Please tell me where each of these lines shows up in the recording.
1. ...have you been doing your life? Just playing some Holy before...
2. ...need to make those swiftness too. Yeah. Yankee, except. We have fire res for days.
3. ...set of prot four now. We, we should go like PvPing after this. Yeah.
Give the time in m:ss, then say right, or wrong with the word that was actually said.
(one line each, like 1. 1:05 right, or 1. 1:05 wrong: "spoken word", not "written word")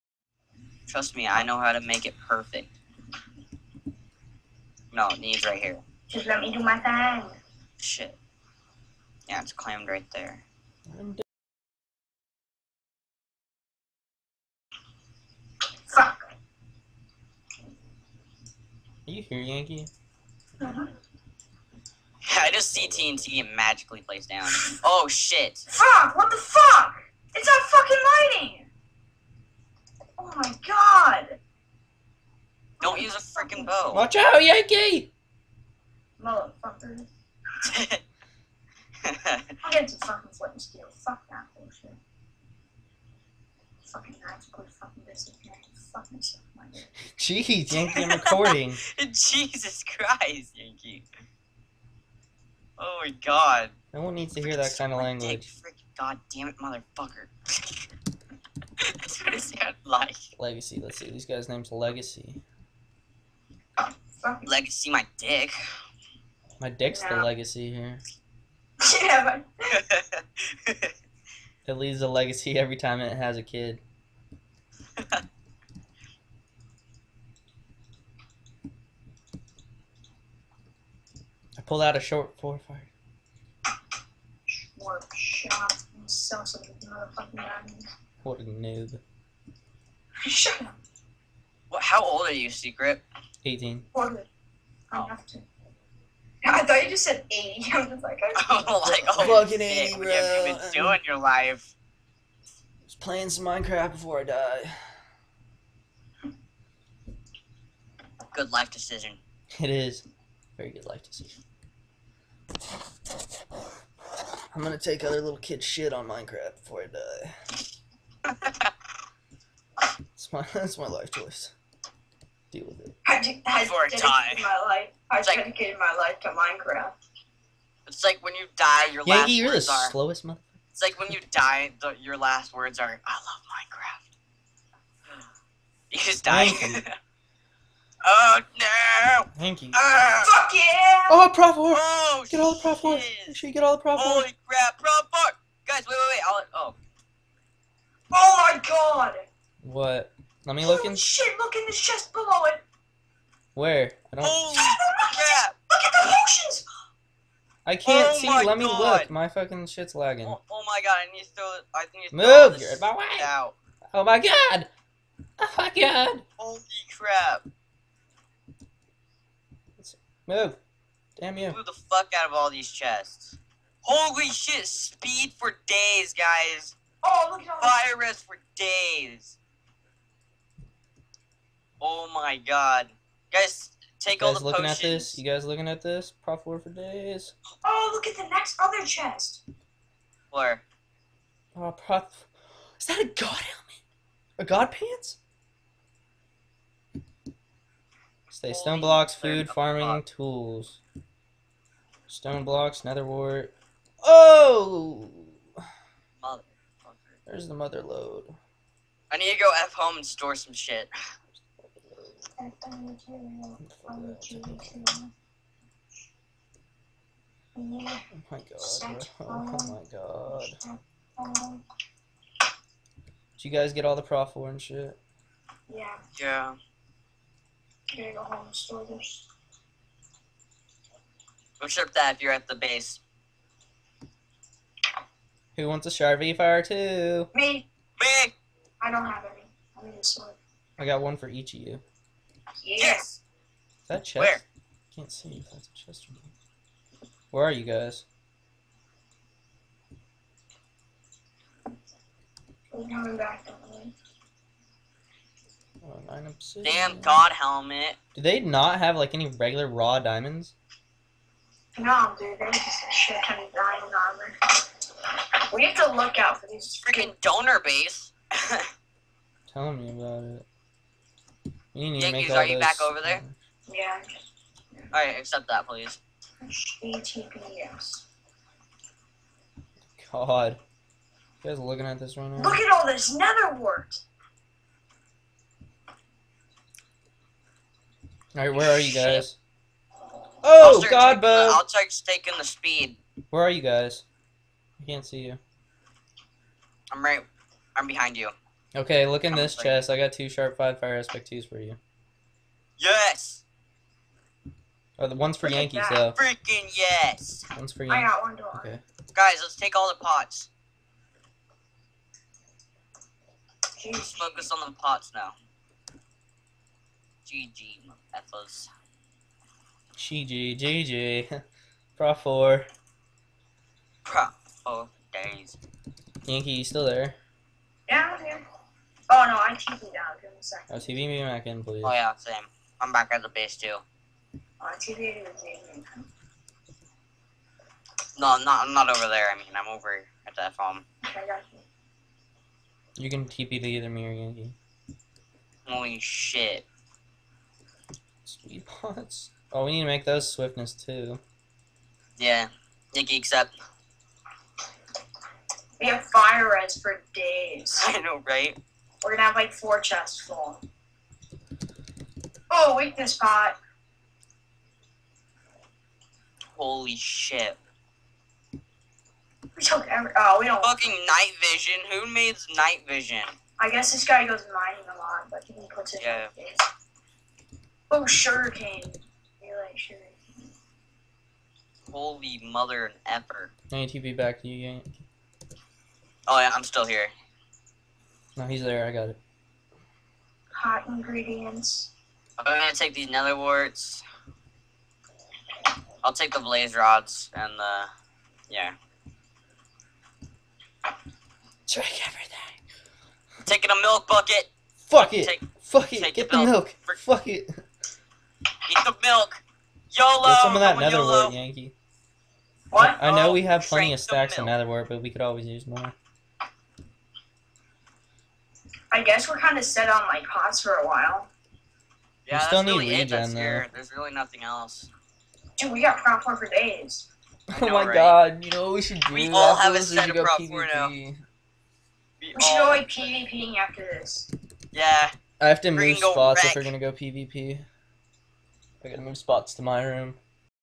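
1. 1:40 wrong: "Minecraft", not "Holy"
2. 5:49 right
3. 7:09 right.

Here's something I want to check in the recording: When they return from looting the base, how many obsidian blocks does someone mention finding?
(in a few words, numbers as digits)
9.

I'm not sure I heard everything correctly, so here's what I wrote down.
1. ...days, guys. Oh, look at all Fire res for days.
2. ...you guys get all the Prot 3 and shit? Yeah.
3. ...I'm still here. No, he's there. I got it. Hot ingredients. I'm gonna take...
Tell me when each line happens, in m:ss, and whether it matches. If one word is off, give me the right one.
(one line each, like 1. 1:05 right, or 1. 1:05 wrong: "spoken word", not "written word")
1. 2:55 right
2. 3:43 wrong: "4", not "3"
3. 6:26 right.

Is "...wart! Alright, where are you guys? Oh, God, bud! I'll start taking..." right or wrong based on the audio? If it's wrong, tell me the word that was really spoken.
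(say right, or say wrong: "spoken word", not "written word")
right.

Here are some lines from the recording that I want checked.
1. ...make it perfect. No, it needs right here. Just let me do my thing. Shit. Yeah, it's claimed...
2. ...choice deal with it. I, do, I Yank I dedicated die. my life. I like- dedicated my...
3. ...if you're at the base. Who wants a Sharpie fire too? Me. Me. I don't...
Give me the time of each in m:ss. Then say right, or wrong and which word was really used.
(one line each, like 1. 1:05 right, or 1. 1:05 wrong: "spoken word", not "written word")
1. 0:01 right
2. 2:01 wrong: "Before", not "Yank"
3. 3:52 right.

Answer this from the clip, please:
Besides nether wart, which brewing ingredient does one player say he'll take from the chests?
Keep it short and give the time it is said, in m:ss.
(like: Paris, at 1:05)
blaze rods, at 6:36.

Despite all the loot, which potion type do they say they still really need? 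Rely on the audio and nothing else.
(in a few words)
regen.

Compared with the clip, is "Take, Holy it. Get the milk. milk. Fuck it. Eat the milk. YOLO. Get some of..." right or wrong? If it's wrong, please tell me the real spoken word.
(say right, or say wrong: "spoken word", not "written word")
wrong: "Fuck", not "Holy".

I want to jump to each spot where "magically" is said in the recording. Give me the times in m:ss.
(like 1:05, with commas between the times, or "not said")
0:23, 0:44.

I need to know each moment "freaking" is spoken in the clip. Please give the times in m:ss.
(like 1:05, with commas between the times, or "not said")
4:26, 5:06.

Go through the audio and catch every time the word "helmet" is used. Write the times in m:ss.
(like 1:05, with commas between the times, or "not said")
3:13, 4:17.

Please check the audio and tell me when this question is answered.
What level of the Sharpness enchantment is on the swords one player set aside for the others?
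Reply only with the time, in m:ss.
5:00.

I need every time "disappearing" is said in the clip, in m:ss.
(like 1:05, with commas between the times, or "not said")
0:45.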